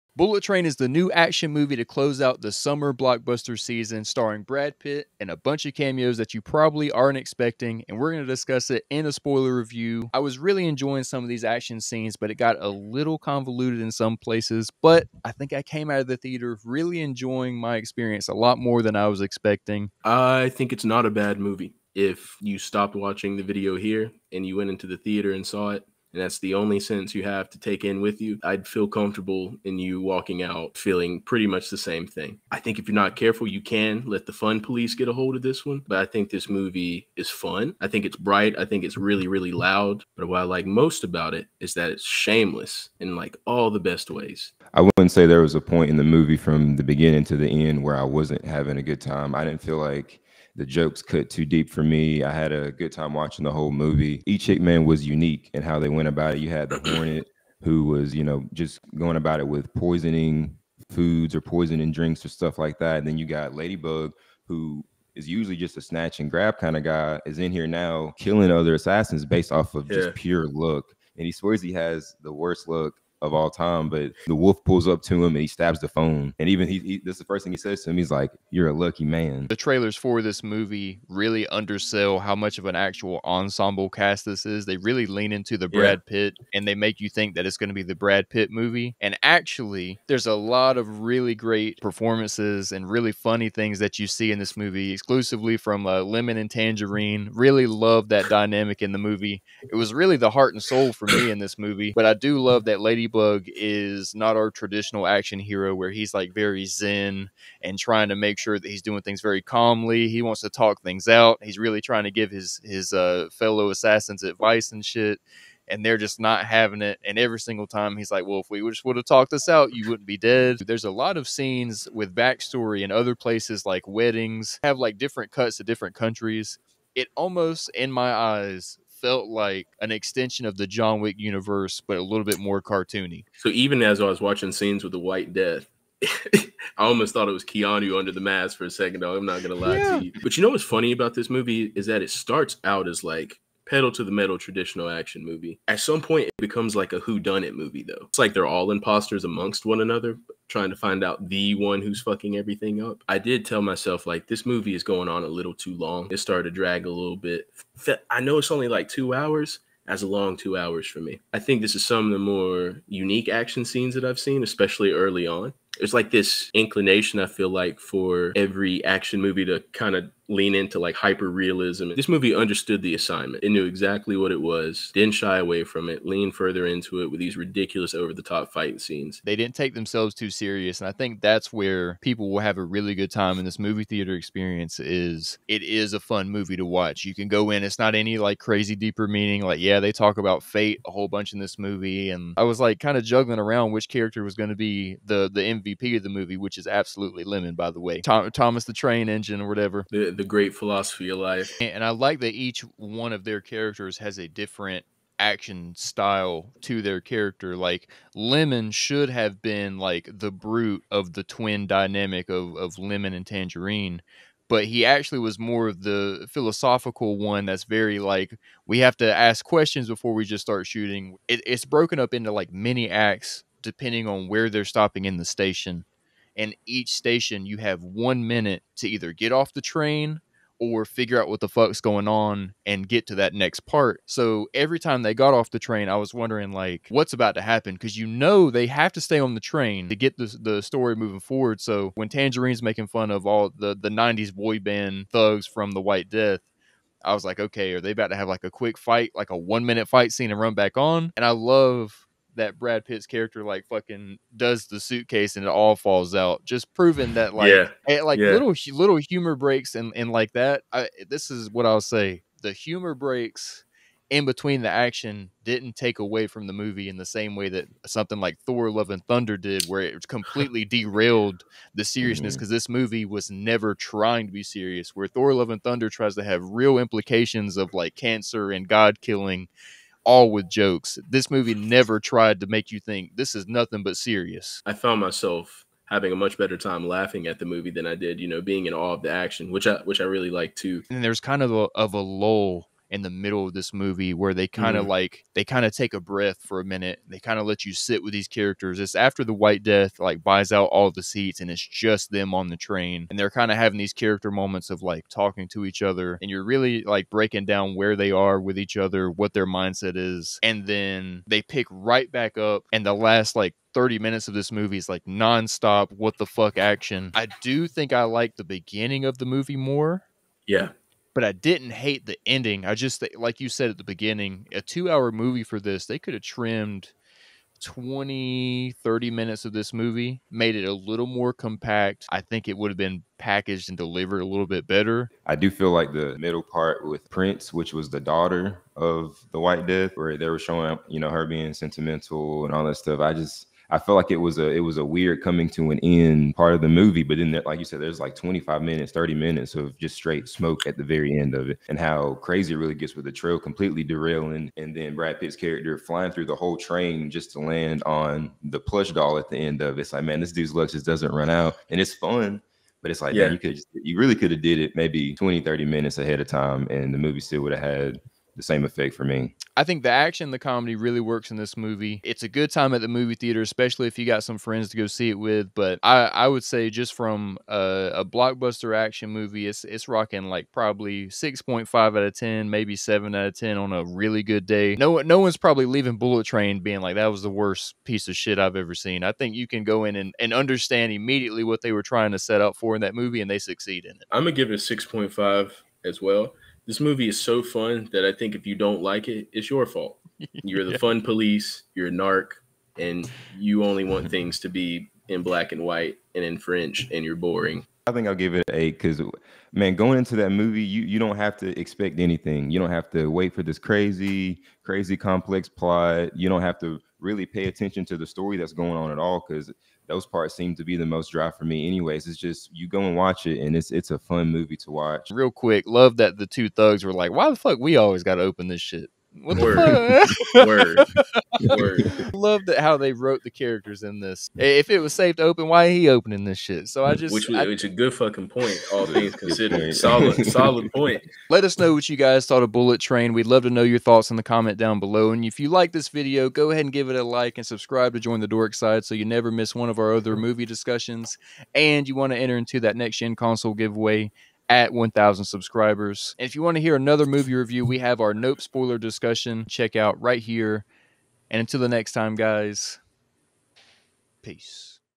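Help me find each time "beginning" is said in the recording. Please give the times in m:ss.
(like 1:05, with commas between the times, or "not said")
0:46, 5:18, 5:23.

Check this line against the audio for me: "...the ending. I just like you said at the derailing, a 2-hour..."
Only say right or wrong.
wrong.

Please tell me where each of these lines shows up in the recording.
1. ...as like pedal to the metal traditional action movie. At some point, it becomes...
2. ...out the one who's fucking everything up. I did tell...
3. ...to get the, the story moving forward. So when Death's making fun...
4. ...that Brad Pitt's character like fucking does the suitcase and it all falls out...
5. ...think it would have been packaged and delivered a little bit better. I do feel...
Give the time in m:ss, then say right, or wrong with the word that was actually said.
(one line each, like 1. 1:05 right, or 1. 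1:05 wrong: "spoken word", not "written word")
1. 2:22 right
2. 2:31 right
3. 3:59 wrong: "Tangerine", not "Death"
4. 4:12 right
5. 5:32 right.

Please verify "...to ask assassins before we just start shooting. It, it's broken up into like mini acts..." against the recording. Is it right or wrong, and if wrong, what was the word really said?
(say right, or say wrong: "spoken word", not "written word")
wrong: "questions", not "assassins".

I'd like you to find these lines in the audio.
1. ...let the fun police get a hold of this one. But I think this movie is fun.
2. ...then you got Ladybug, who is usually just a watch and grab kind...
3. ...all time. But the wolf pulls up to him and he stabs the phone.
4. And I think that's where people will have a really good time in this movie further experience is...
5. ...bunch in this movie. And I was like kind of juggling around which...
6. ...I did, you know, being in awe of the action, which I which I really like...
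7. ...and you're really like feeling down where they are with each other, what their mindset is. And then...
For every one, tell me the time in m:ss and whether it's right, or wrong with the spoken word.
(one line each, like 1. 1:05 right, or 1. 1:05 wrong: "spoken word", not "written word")
1. 0:34 right
2. 1:03 wrong: "snatch", not "watch"
3. 1:13 right
4. 3:00 wrong: "theater", not "further"
5. 3:11 right
6. 4:47 right
7. 5:06 wrong: "breaking", not "feeling".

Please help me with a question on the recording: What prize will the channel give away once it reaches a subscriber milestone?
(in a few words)
Next gen console.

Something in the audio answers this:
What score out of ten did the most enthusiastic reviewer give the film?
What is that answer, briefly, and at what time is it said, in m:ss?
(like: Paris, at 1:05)
8, at 6:48.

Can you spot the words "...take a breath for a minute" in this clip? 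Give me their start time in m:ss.
4:55.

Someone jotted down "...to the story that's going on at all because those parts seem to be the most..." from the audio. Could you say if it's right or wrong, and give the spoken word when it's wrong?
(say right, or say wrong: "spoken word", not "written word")
right.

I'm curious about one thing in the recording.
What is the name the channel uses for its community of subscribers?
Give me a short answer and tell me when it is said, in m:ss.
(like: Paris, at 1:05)
The Dork side, at 7:28.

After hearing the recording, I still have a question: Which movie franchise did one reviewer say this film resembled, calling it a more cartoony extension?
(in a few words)
John Wick.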